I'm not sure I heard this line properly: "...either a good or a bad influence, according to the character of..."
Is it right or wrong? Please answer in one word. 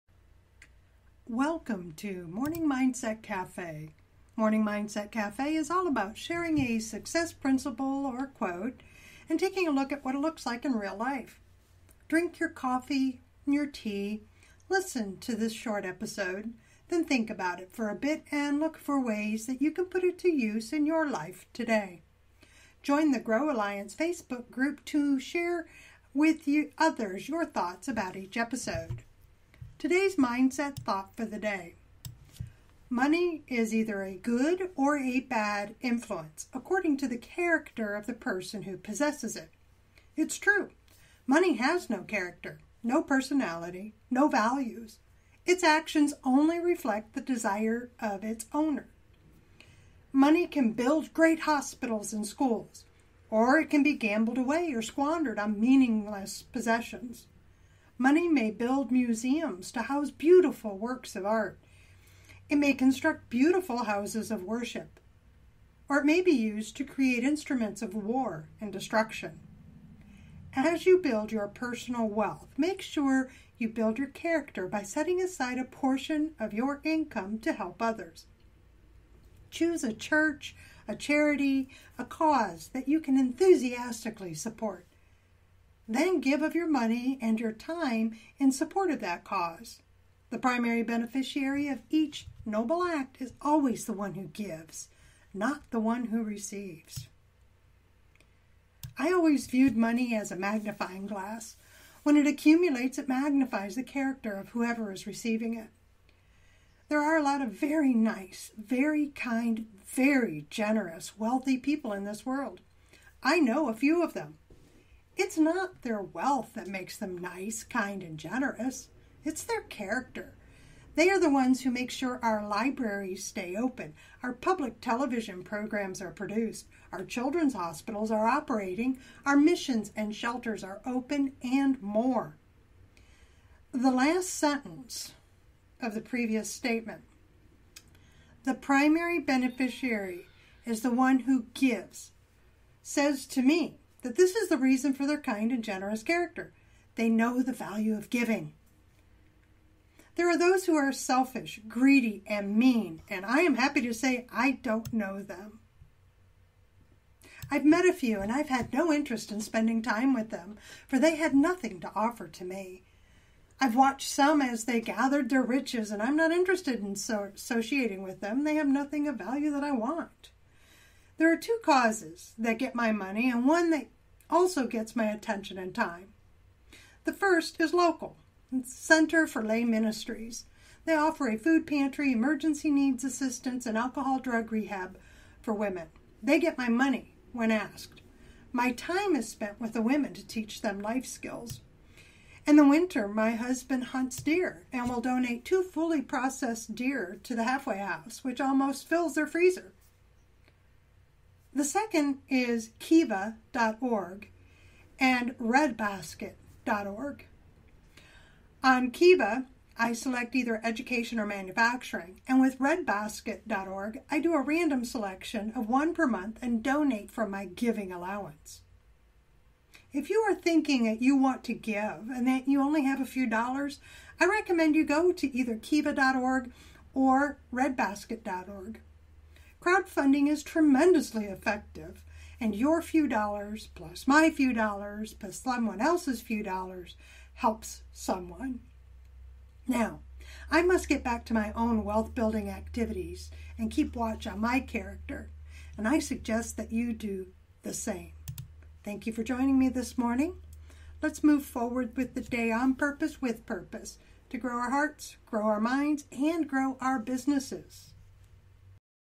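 right.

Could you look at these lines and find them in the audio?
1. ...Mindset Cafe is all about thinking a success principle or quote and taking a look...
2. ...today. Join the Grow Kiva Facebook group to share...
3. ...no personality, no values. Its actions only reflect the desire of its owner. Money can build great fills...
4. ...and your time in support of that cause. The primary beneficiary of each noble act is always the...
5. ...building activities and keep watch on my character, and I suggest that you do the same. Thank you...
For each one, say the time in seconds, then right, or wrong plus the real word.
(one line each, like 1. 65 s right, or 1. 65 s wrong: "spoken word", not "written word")
1. 4 s wrong: "sharing", not "thinking"
2. 21 s wrong: "Alliance", not "Kiva"
3. 42 s wrong: "hospitals", not "fills"
4. 87 s right
5. 242 s right.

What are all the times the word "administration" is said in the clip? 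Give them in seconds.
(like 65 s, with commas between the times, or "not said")
not said.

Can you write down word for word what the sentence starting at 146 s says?
They know the value of giving.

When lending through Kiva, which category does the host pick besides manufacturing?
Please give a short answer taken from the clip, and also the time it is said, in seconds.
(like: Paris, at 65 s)
education, at 210 s.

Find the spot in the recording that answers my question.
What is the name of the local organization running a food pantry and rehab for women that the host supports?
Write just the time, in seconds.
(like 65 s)
178 s.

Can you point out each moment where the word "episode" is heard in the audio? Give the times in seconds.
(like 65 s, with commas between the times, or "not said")
15 s, 28 s.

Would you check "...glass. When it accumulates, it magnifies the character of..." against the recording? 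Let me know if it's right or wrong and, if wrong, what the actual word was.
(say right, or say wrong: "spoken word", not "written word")
right.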